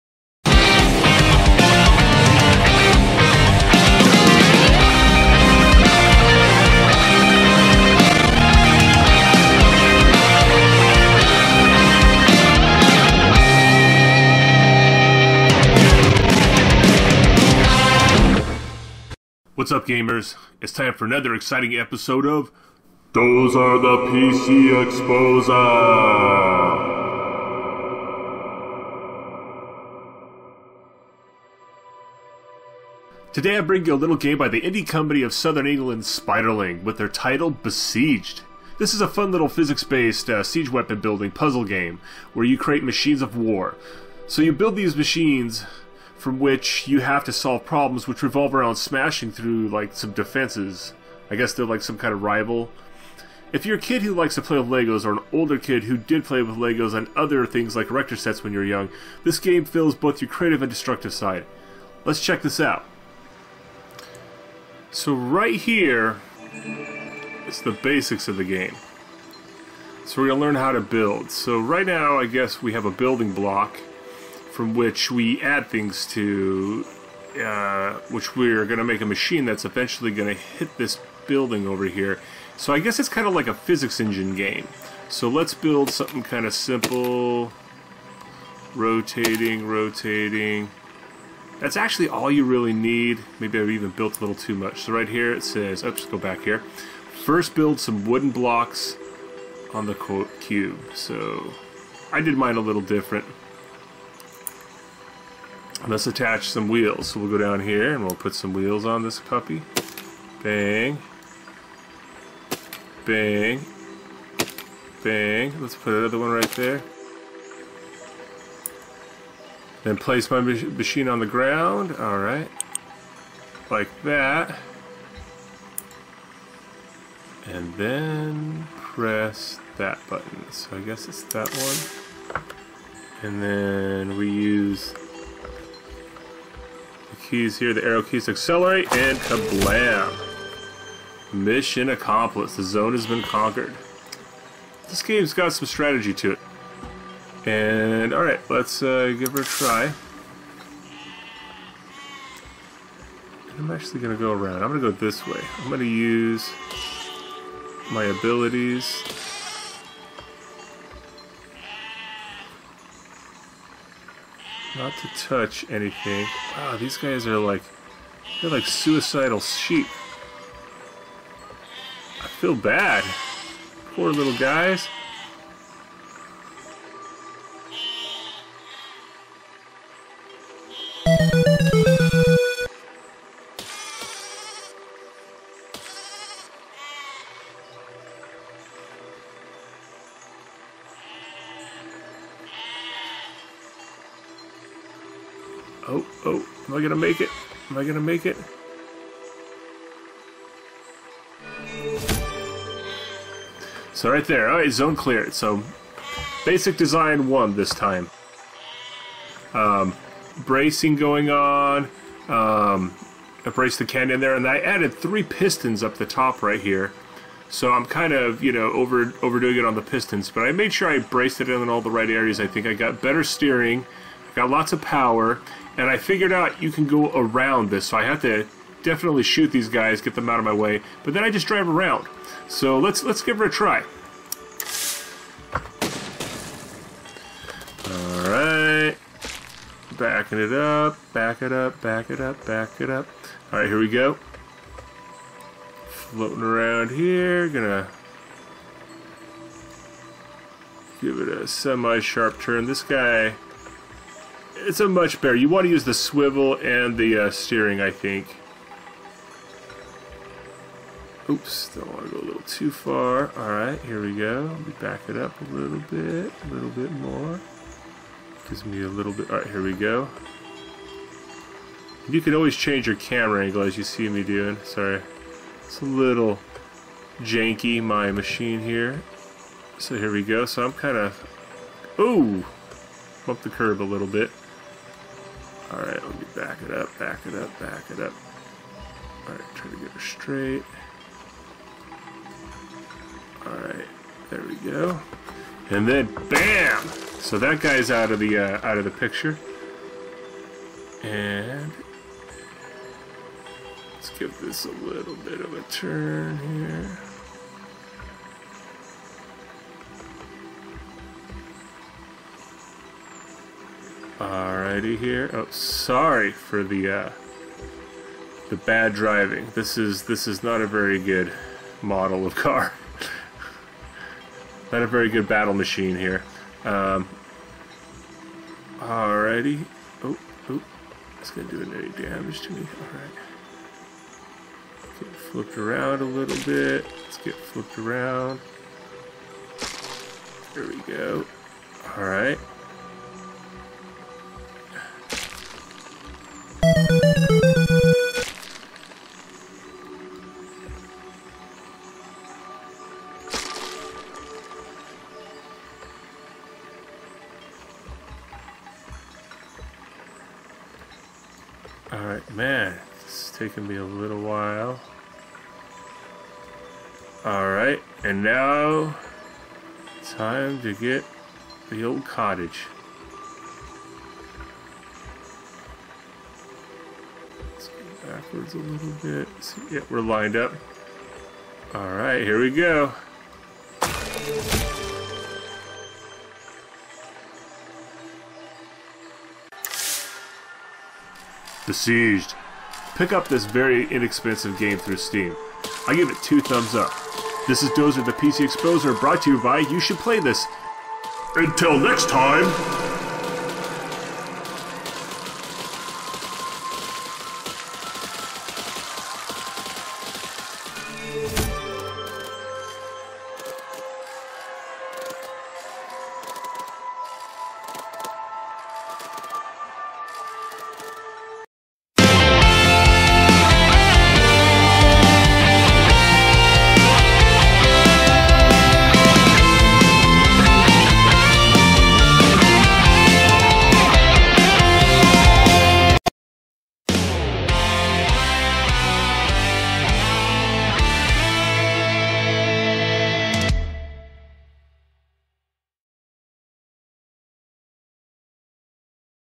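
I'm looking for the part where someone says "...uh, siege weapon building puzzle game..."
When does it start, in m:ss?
0:40.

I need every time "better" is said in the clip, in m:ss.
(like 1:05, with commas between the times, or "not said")
3:43, 4:15.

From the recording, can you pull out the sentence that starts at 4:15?
You want to use the swivel and the uh, steering, I think.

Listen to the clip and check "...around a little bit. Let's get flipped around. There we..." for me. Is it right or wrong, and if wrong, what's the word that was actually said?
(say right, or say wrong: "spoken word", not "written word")
right.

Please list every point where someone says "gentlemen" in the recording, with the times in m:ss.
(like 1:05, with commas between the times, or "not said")
not said.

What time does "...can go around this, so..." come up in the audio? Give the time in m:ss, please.
3:46.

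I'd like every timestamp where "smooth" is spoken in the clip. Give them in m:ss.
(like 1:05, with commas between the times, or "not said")
not said.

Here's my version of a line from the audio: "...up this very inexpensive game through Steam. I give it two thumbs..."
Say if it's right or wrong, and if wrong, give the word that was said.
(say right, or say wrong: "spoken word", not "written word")
right.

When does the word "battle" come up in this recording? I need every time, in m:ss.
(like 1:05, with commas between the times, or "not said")
5:25.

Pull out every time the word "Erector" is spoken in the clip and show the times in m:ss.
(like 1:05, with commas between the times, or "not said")
0:57.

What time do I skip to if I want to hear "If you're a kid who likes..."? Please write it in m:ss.
0:53.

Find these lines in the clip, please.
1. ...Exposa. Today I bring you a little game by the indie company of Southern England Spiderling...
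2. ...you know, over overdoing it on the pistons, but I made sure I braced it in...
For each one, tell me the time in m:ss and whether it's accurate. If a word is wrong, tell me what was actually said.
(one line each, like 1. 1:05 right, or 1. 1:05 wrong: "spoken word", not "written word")
1. 0:24 right
2. 3:38 right.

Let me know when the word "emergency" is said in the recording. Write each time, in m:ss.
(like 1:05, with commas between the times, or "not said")
not said.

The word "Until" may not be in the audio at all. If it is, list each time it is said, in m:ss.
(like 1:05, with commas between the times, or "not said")
6:41.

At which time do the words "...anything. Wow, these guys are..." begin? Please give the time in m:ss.
2:45.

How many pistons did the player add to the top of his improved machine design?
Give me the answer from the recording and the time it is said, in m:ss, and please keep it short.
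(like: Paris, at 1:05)
3, at 3:34.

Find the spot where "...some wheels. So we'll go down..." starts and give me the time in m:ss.
1:46.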